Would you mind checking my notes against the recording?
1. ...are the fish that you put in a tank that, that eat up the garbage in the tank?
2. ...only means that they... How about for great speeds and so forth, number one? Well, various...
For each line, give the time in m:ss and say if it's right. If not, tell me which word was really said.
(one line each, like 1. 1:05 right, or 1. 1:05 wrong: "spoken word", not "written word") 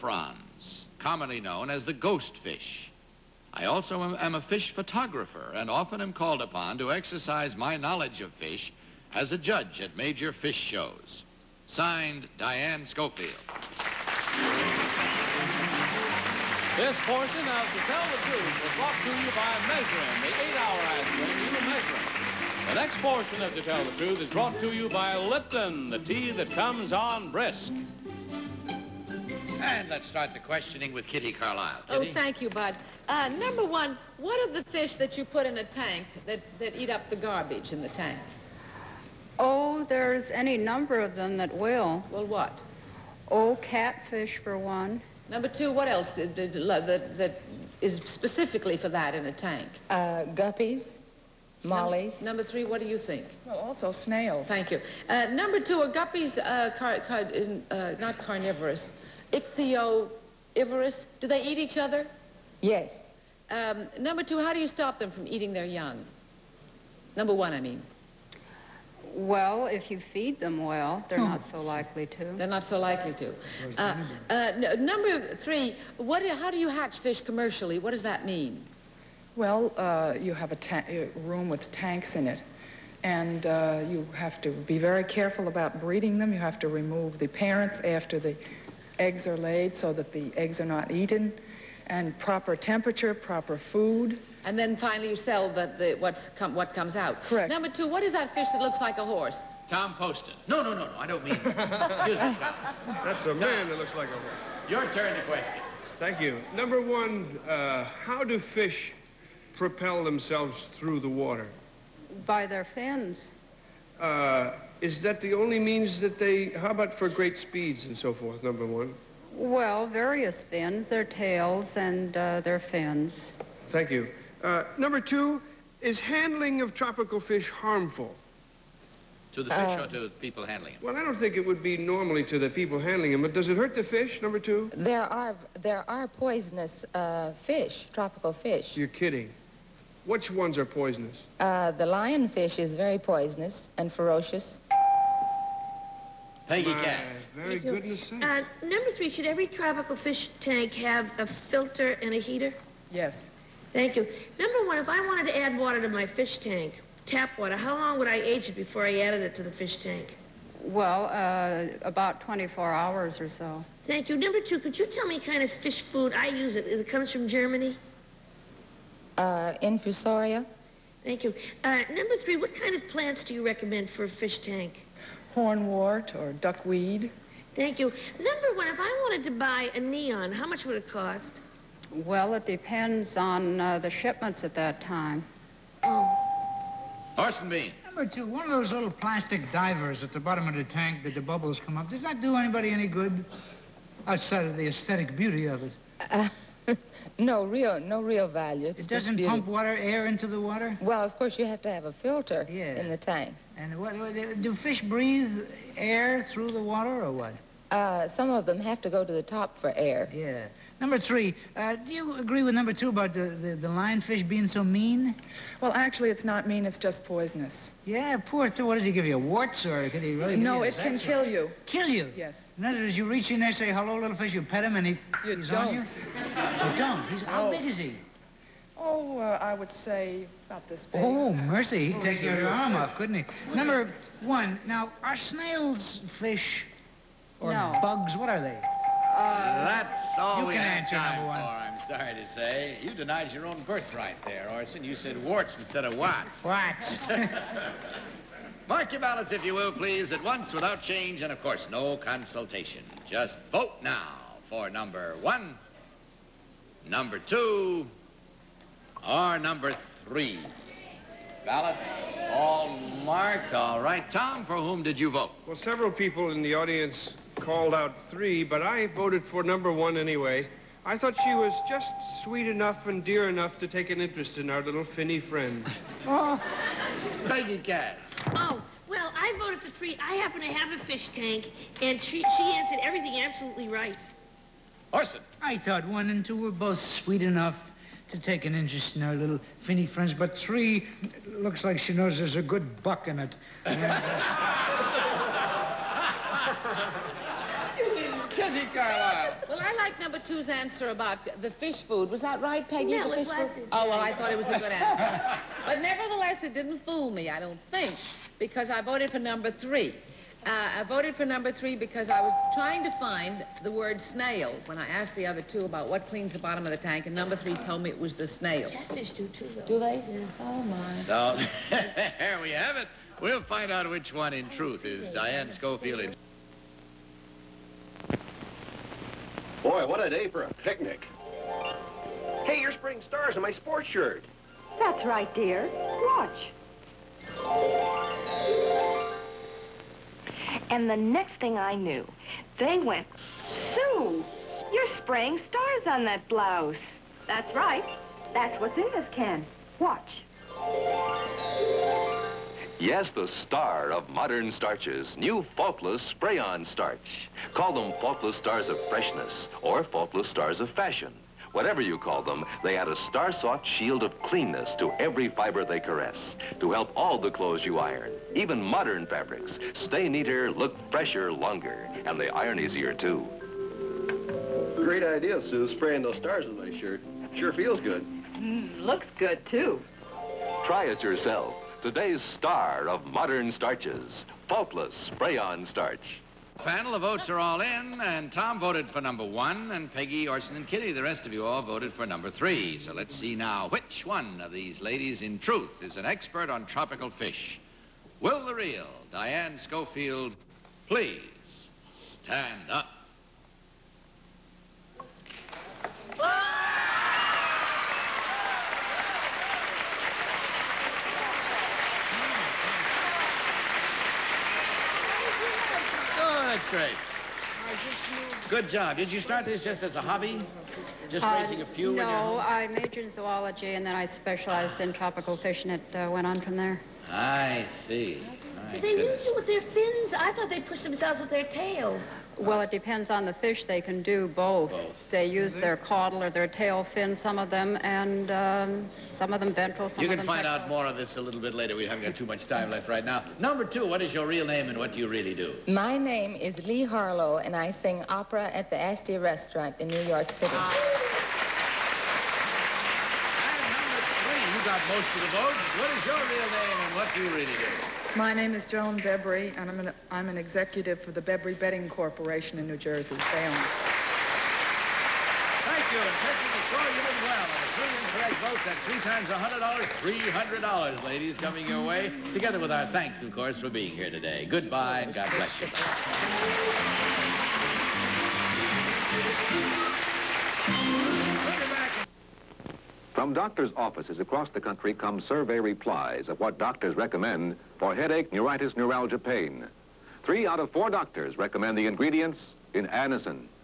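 1. 0:34 right
2. 1:55 right.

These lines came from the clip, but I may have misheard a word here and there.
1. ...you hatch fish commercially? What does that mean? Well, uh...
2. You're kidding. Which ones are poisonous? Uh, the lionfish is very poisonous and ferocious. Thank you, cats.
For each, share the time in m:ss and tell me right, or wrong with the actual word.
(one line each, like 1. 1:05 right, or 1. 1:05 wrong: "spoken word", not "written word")
1. 1:16 right
2. 2:18 right.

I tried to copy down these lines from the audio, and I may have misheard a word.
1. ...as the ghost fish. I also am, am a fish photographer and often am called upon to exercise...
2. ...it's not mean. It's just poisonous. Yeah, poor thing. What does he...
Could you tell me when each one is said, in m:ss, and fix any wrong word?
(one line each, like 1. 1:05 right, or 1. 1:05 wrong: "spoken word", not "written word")
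1. 0:01 right
2. 3:36 right.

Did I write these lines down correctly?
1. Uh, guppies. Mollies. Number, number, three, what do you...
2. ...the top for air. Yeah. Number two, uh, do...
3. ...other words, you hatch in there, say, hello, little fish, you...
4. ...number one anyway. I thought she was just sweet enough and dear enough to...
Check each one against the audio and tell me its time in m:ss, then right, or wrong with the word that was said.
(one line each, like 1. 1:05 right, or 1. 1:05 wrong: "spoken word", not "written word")
1. 0:49 right
2. 3:29 wrong: "three", not "two"
3. 3:42 wrong: "reach", not "hatch"
4. 4:29 right.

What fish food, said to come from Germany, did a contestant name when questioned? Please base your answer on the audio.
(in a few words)
Infusoria.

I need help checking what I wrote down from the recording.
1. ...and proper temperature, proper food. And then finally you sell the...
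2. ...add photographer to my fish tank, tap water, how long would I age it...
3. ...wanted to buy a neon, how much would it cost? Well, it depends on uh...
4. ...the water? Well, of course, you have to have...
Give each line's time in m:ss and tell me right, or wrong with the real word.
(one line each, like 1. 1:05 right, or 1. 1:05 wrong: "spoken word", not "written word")
1. 1:31 right
2. 2:35 wrong: "water", not "photographer"
3. 2:59 right
4. 3:20 right.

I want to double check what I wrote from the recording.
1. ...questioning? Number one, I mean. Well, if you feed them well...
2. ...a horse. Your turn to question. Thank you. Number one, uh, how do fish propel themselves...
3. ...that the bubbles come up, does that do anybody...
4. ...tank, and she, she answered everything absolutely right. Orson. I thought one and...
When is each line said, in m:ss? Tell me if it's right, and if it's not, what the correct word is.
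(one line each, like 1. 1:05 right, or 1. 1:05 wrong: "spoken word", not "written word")
1. 1:05 wrong: "young", not "questioning"
2. 1:44 right
3. 3:11 right
4. 4:41 right.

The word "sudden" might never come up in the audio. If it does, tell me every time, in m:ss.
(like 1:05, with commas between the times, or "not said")
not said.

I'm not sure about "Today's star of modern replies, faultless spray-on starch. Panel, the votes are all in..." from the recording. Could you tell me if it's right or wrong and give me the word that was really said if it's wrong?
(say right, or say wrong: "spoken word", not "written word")
wrong: "starches", not "replies".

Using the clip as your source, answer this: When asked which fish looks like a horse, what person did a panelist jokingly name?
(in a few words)
Tom Poston.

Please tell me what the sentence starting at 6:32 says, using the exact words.
So let's see now which one of these ladies, in truth, is an expert on tropical fish.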